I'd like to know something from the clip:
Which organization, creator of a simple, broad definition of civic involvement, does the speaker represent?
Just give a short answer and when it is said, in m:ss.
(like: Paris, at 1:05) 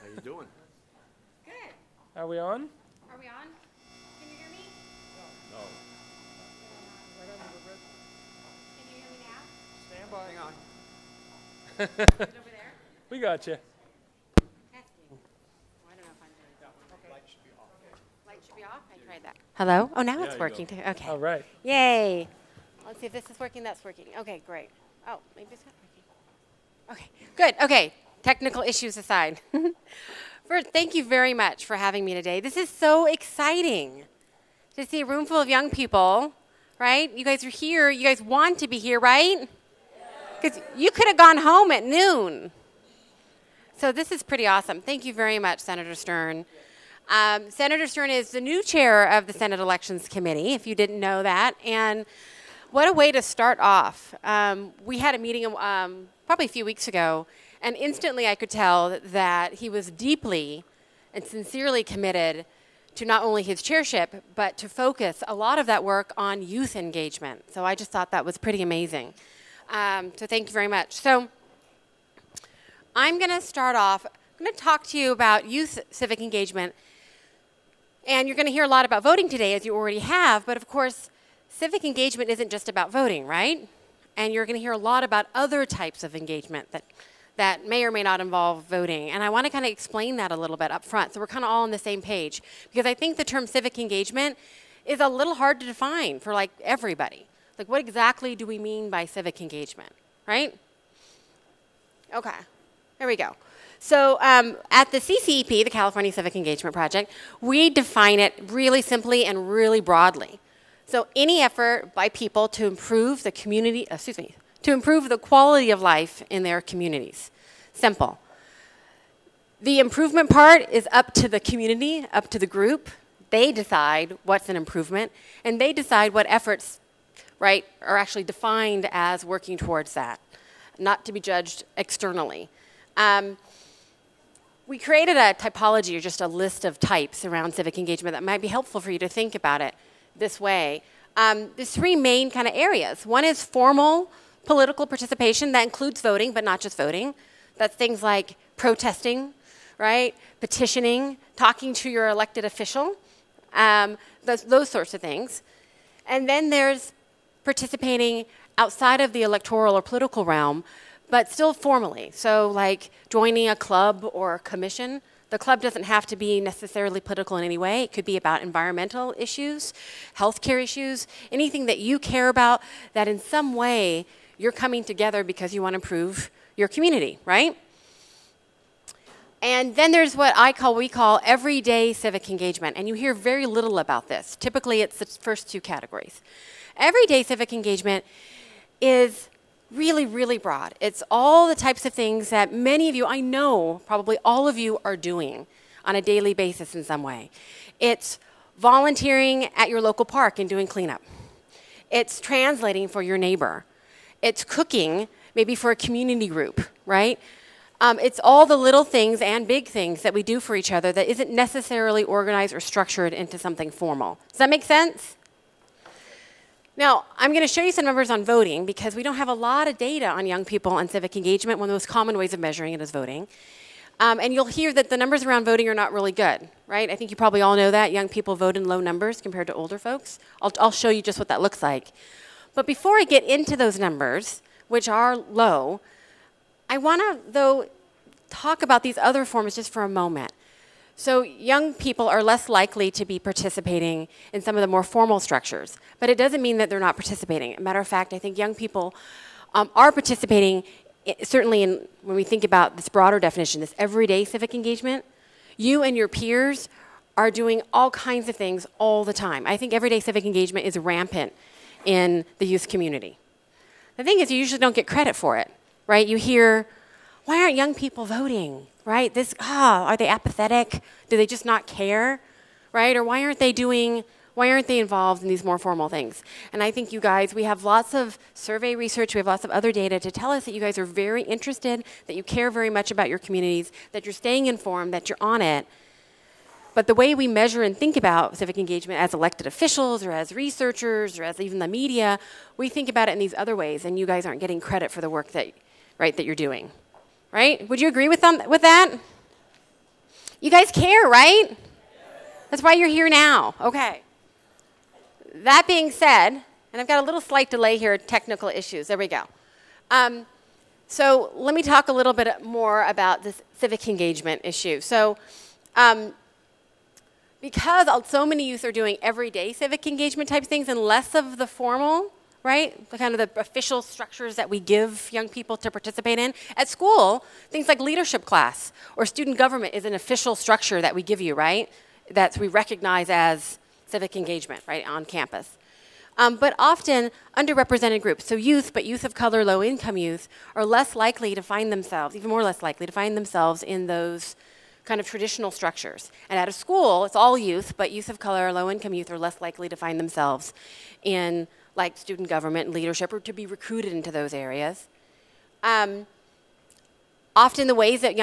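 California Civic Engagement Project, at 1:45.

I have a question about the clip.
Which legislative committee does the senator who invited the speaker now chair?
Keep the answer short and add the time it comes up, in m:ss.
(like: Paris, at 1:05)
Senate Elections Committee, at 0:49.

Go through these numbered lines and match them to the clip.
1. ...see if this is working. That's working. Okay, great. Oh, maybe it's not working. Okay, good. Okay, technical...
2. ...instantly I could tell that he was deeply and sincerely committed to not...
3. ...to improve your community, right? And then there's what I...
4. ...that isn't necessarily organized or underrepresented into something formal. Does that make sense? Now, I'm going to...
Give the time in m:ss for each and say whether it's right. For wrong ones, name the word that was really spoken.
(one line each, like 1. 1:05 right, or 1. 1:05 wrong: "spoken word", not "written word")
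1. 0:22 right
2. 0:57 right
3. 2:55 right
4. 3:30 wrong: "structured", not "underrepresented".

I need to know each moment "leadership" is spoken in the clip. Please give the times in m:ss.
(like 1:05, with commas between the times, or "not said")
5:27, 5:52.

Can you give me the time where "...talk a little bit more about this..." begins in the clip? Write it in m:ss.
5:11.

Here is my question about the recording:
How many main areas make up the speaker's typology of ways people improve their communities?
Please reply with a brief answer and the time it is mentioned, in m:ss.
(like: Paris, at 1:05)
3, at 2:21.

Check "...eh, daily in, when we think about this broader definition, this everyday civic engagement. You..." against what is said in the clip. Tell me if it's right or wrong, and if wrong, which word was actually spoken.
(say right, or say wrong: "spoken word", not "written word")
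wrong: "certainly", not "daily".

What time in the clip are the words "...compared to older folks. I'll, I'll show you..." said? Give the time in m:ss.
3:49.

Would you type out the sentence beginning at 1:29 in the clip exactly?
And I want to kind of explain that a little bit up front so we're kind of all on the same page.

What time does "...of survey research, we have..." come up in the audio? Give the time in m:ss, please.
4:37.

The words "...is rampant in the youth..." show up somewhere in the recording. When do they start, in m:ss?
4:20.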